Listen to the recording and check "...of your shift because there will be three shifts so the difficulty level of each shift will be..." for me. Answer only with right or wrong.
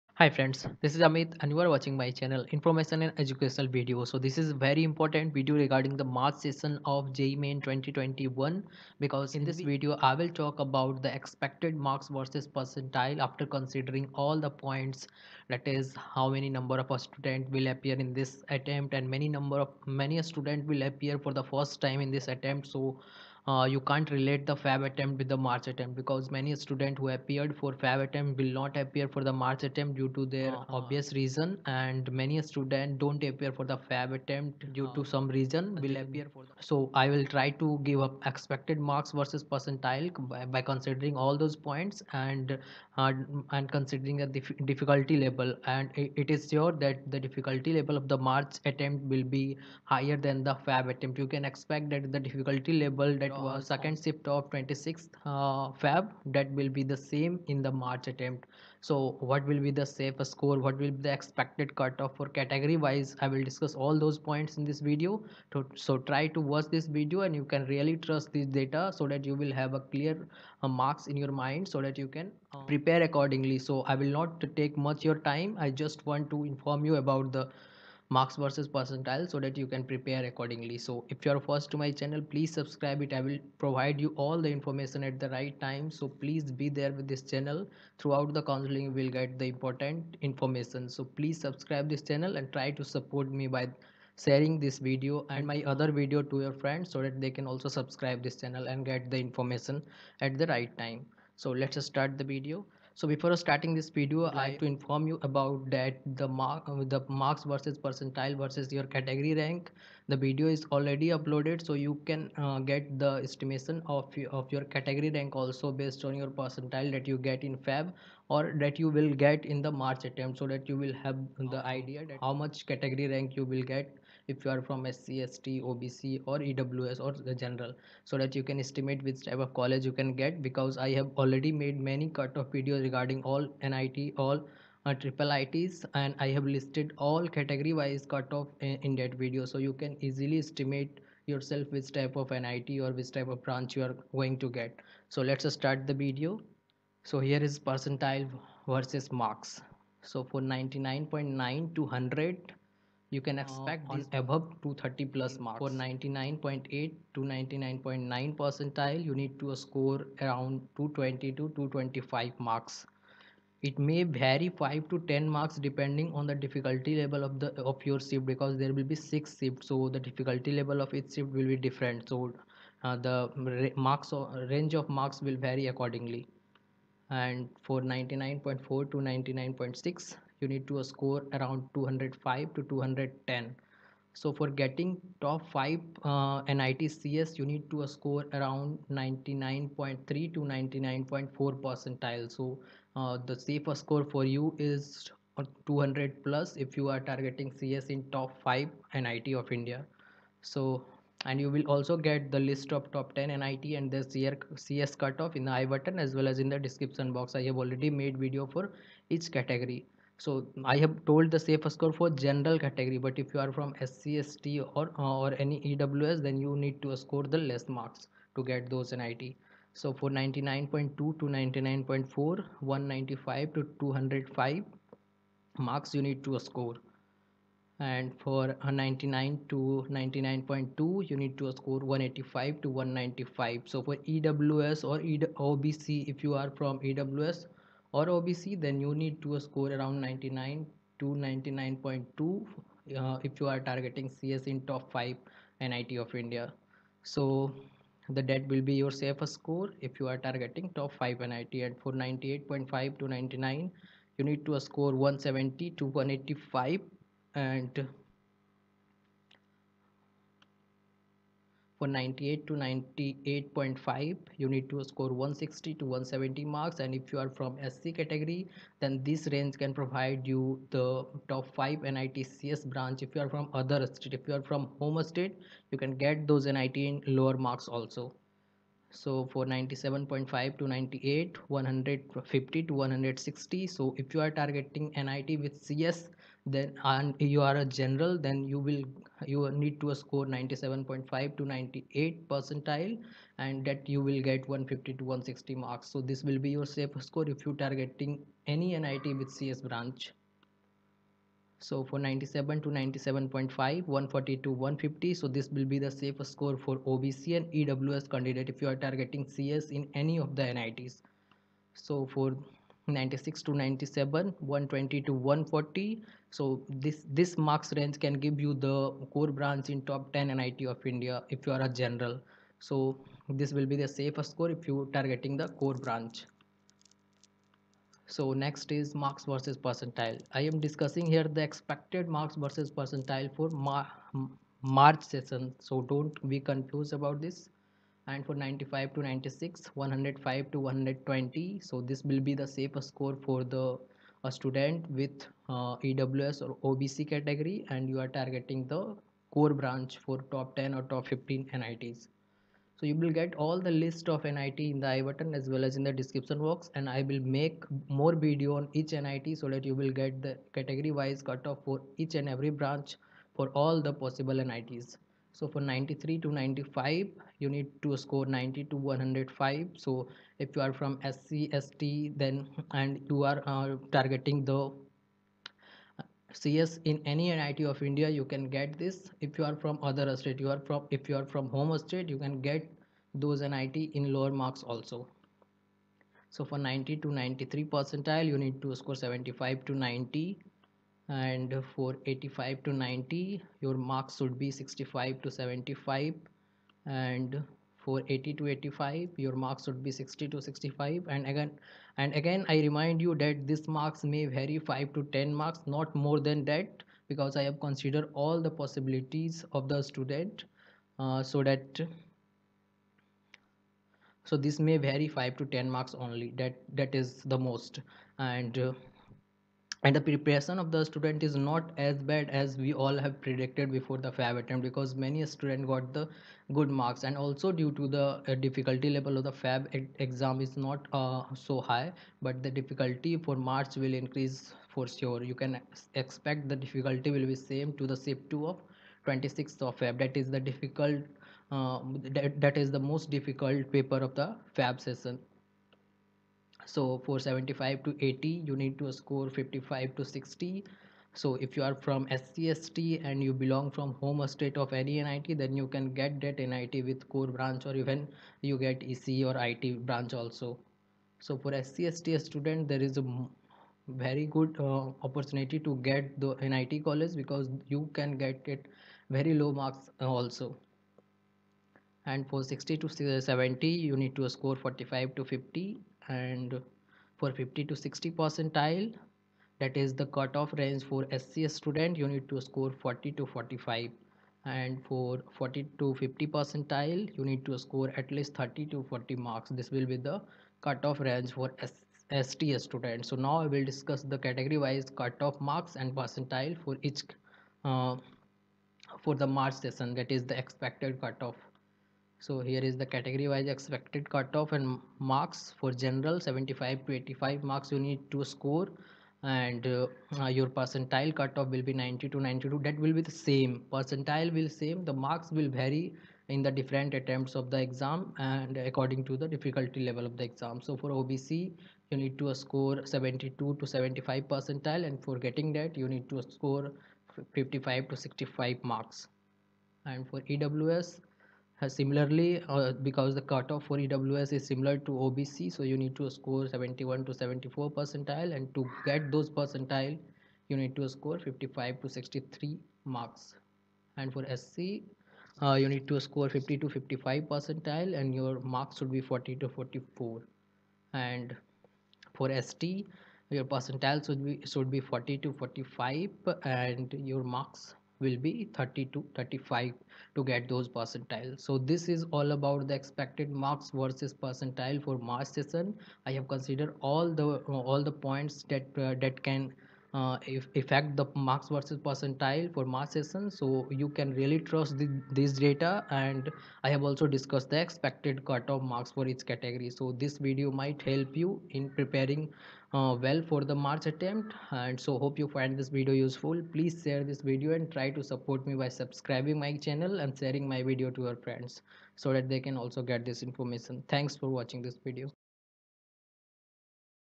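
wrong.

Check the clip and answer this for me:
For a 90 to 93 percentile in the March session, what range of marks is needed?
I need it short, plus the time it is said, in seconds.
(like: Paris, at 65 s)
75 to 90, at 389 s.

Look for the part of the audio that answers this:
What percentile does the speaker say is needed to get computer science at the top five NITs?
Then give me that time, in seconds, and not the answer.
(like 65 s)
188 s.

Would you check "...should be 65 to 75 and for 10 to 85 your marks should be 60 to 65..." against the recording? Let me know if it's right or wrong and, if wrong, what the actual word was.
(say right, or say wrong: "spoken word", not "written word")
wrong: "80", not "10".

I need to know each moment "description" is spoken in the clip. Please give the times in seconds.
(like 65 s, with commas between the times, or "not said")
206 s, 355 s.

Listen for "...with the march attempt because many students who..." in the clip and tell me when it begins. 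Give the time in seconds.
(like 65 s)
25 s.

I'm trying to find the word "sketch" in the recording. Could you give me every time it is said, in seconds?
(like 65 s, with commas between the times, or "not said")
not said.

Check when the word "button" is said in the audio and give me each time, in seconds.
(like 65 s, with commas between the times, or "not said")
205 s, 355 s.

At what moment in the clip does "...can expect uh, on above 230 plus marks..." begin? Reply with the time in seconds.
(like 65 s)
153 s.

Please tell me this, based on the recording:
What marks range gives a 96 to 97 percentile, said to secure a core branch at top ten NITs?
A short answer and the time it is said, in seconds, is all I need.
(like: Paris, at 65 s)
120 to 140, at 314 s.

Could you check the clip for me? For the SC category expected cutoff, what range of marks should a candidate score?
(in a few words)
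40 to 44.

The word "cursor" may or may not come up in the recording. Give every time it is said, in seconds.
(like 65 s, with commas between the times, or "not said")
not said.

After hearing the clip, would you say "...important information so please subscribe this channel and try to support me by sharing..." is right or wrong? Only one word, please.
right.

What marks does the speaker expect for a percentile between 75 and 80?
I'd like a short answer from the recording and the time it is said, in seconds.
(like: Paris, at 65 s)
55 to 60, at 449 s.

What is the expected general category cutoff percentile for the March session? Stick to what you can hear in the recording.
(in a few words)
90 to 92.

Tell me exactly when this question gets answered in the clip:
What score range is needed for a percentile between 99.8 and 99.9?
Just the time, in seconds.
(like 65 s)
160 s.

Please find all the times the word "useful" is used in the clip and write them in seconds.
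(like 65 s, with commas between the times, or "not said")
585 s.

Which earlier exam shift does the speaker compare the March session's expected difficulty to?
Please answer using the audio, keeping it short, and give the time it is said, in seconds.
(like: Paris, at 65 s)
Second shift of 26th Feb, at 53 s.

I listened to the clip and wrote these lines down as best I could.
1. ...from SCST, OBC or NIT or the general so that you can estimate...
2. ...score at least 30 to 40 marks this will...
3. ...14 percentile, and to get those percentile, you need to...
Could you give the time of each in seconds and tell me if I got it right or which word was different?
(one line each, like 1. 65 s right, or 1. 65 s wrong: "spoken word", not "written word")
1. 124 s wrong: "EWS", not "NIT"
2. 487 s right
3. 537 s wrong: "74", not "14".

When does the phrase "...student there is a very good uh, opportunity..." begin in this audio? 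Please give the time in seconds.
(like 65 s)
462 s.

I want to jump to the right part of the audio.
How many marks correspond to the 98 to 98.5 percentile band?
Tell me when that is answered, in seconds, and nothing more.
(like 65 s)
265 s.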